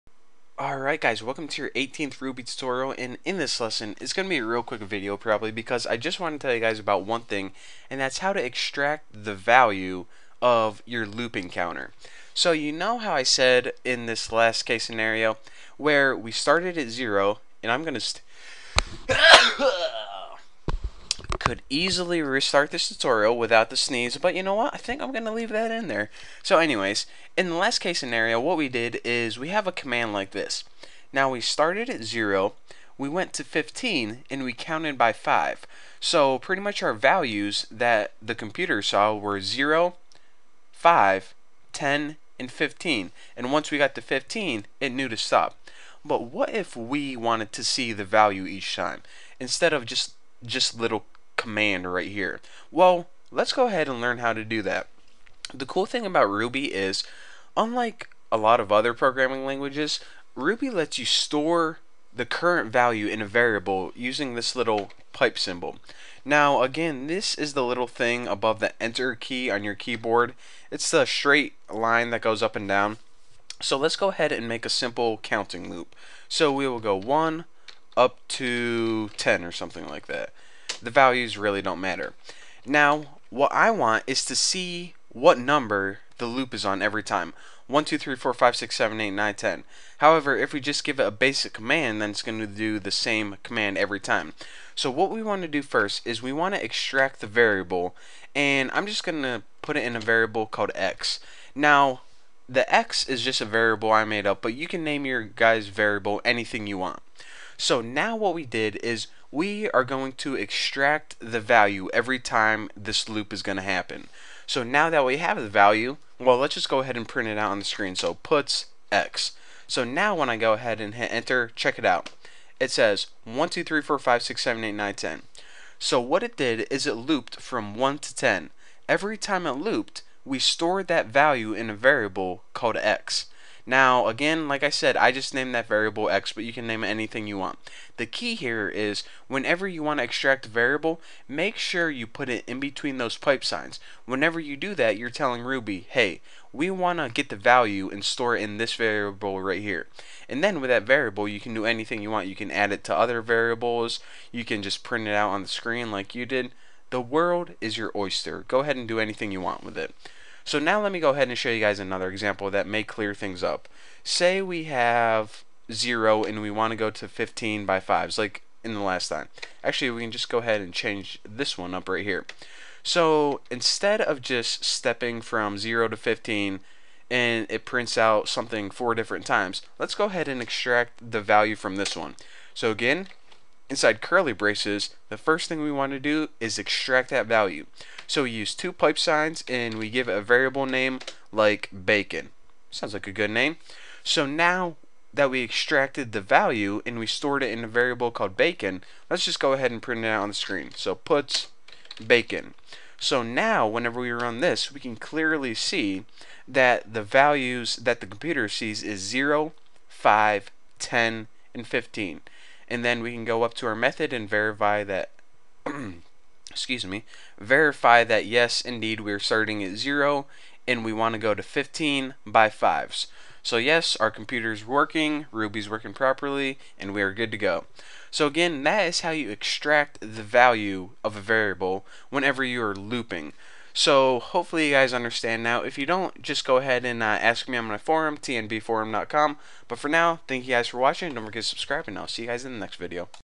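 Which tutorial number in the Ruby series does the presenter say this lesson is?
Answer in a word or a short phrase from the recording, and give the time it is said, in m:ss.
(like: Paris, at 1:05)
18th, at 0:01.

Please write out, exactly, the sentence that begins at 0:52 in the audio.
Well, let's go ahead and learn how to do that.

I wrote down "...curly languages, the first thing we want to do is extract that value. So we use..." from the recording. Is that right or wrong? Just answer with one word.
wrong.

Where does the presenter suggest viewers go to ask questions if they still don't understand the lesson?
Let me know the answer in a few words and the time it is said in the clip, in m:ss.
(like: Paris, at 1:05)
tnbforum.com, at 3:58.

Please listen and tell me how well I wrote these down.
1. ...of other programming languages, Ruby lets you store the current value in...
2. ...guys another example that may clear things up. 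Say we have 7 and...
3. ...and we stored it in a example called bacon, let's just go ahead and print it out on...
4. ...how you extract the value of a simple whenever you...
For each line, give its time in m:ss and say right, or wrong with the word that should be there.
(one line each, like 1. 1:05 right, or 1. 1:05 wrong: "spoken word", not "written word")
1. 0:58 right
2. 2:41 wrong: "0", not "7"
3. 3:16 wrong: "variable", not "example"
4. 3:49 wrong: "variable", not "simple".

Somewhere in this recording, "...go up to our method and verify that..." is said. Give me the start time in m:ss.
3:33.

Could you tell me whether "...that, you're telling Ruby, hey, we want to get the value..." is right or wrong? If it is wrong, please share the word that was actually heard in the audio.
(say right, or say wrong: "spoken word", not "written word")
right.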